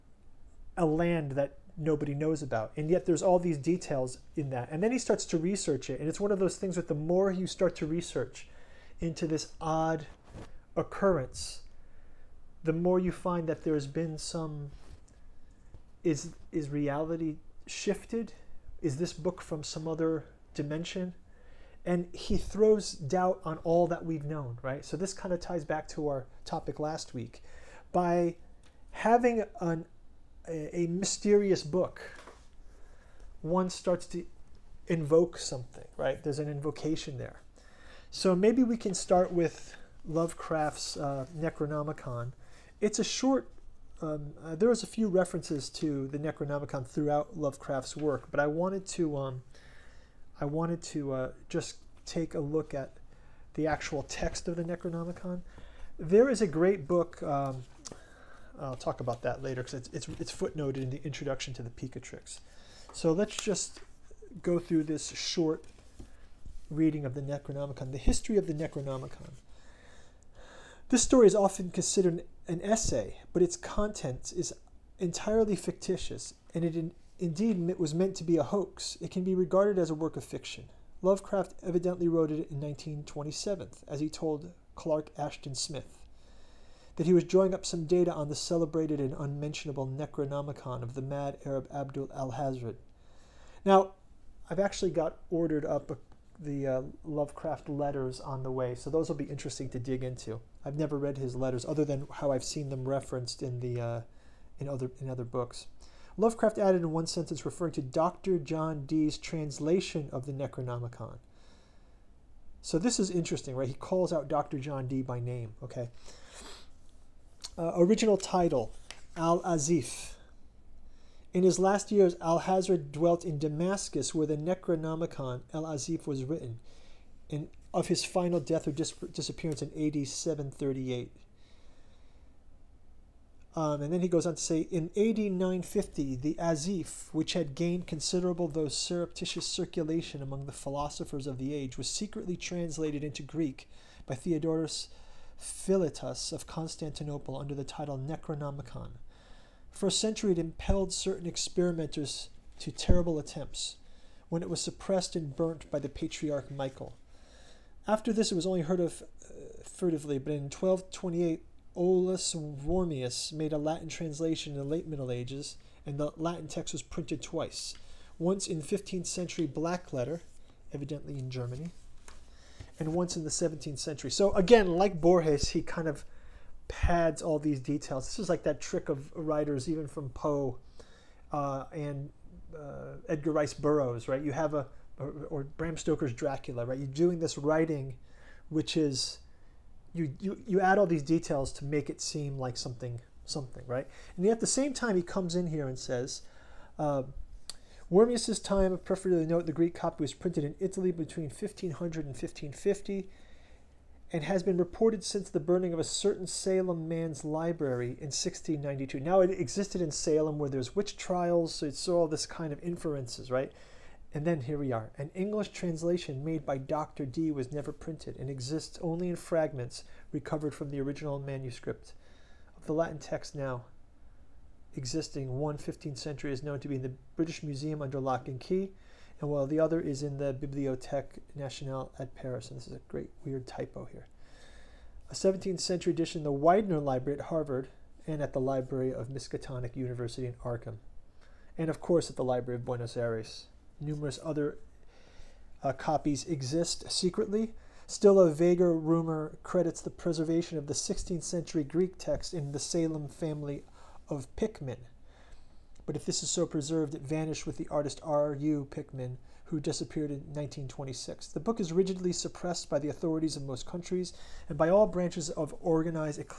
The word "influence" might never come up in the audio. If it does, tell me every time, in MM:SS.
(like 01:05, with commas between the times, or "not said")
not said.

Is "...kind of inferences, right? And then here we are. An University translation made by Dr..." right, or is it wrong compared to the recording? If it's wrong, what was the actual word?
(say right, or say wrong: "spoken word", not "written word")
wrong: "English", not "University".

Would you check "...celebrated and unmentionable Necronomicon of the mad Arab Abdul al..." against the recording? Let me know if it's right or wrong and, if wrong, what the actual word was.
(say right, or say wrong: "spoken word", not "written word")
right.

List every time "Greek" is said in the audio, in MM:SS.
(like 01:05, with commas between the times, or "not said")
02:23, 03:19, 04:11.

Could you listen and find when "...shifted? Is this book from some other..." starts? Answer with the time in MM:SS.
00:17.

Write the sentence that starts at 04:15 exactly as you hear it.
But if this is so preserved, it vanished with the artist R.U.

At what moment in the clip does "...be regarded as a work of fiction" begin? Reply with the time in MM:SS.
01:19.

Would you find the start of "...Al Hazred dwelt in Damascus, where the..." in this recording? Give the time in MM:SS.
02:02.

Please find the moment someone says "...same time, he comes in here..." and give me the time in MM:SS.
03:14.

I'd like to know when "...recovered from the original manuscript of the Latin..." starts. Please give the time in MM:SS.
03:40.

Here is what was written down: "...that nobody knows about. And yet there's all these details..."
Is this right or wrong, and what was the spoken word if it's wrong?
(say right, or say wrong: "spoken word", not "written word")
right.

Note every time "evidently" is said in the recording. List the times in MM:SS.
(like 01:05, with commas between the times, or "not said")
01:21, 02:50.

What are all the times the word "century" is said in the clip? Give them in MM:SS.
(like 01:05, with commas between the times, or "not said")
02:29, 02:49, 02:53, 03:45, 03:55, 04:11.